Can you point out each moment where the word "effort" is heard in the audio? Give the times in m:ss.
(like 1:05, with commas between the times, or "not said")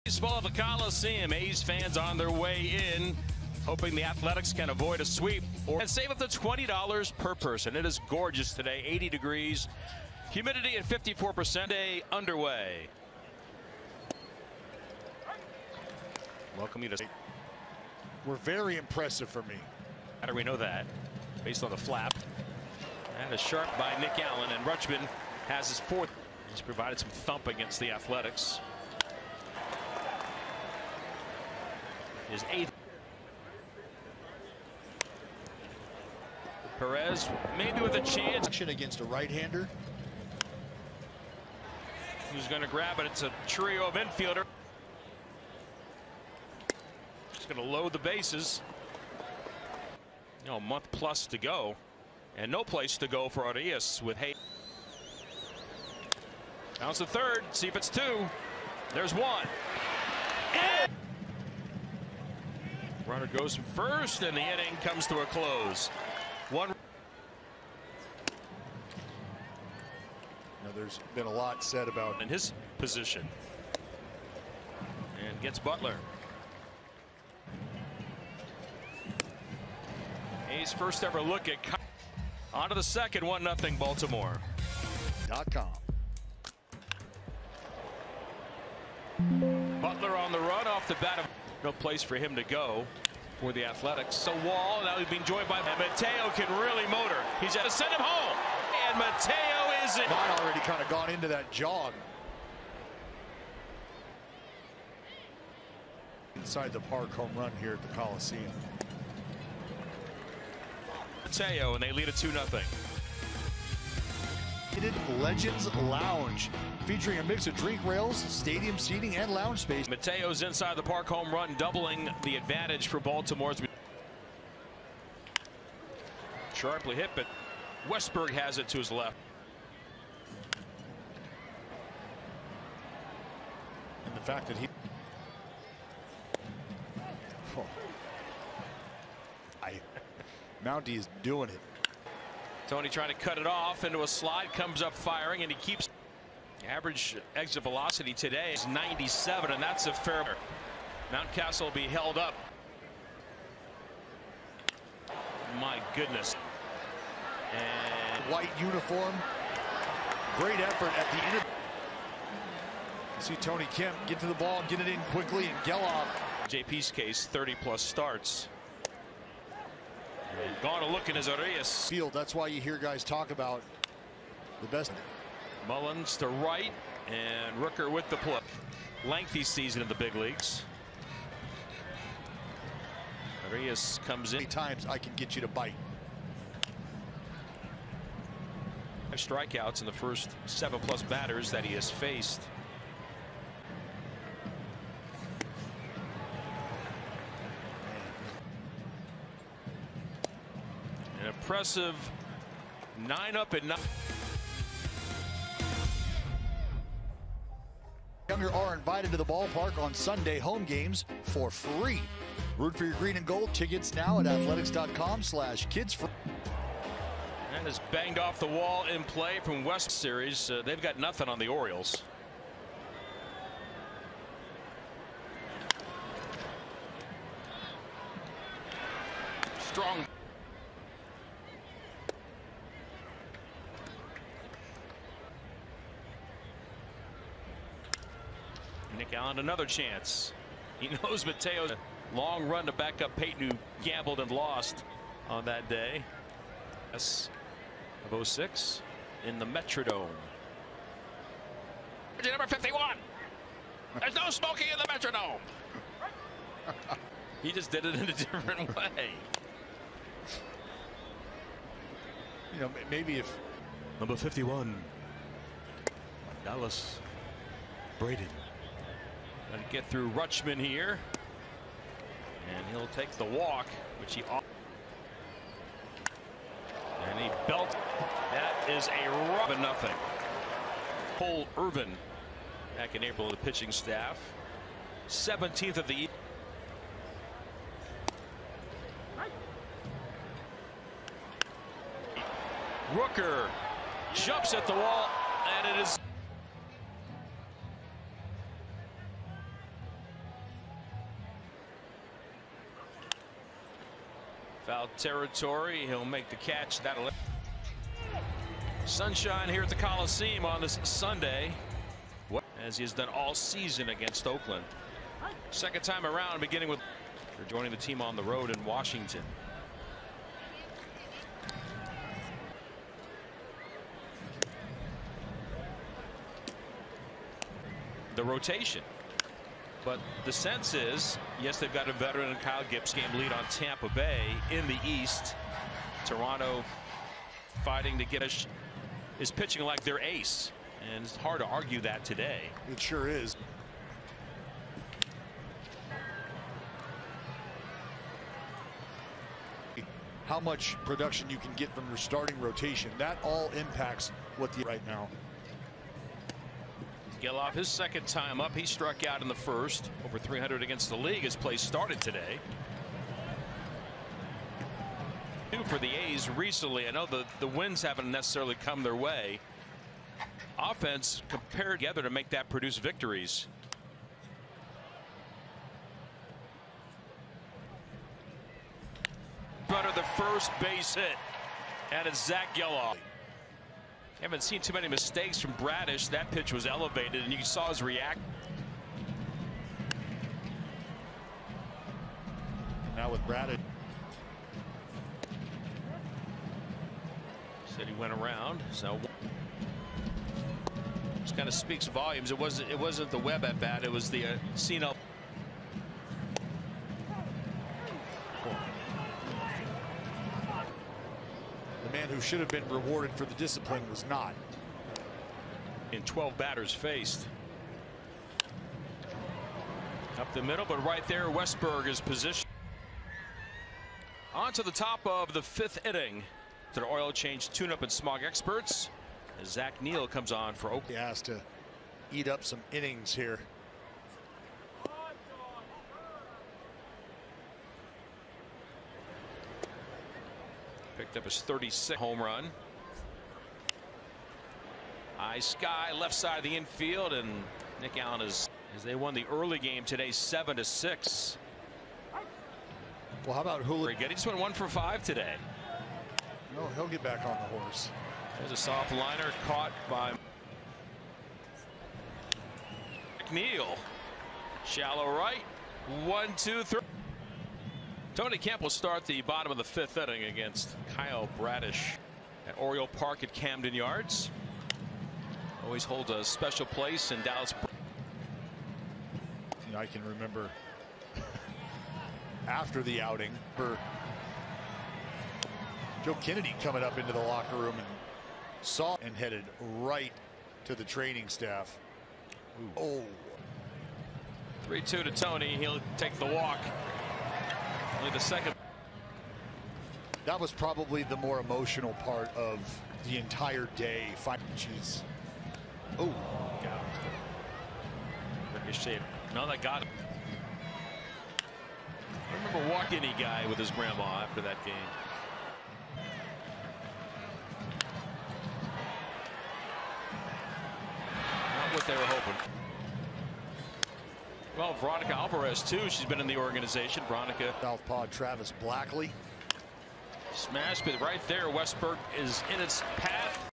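2:40.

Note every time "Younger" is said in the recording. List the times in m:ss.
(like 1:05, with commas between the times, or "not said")
3:28.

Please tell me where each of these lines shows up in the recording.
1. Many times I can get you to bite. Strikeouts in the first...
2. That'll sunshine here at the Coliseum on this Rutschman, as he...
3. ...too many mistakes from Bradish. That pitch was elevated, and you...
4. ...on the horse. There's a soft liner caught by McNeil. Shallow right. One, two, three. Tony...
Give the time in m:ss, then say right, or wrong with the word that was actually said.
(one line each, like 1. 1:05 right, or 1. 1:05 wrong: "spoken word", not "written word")
1. 3:04 right
2. 5:06 wrong: "Sunday", not "Rutschman"
3. 6:24 right
4. 7:37 right.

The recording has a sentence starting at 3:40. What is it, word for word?
Uh, they've got nothing on the Orioles.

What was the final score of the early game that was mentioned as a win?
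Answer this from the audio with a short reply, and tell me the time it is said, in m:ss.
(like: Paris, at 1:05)
7 to 6, at 7:30.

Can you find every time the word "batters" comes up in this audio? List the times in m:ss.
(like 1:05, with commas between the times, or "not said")
3:11, 6:56.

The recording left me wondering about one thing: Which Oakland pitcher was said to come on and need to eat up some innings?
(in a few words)
Zach Neal.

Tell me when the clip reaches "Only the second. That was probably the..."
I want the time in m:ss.
8:18.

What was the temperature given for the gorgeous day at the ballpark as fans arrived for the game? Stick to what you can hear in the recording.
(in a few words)
80 degrees.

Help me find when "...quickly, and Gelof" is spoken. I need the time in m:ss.
2:45.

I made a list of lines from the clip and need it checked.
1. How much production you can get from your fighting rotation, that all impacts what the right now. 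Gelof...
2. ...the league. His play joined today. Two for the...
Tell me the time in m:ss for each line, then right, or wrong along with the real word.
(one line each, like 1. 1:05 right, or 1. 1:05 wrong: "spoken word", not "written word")
1. 5:50 wrong: "starting", not "fighting"
2. 6:00 wrong: "started", not "joined".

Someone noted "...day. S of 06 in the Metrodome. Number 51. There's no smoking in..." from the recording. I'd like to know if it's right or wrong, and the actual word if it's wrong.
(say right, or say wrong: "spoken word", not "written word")
right.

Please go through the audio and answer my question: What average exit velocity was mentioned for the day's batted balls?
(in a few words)
97.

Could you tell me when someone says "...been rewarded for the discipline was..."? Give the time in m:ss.
6:52.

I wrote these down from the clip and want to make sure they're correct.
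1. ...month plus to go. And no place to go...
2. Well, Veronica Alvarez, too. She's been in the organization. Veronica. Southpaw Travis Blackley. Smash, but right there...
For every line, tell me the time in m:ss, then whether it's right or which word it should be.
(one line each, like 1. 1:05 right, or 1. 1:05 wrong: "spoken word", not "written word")
1. 0:50 right
2. 8:44 right.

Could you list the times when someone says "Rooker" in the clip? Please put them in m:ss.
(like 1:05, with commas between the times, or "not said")
2:57, 4:52.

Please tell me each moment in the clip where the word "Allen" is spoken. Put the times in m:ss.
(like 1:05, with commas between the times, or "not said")
0:24, 3:59, 7:27.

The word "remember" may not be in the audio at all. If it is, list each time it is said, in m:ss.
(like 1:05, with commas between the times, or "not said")
8:00, 8:32.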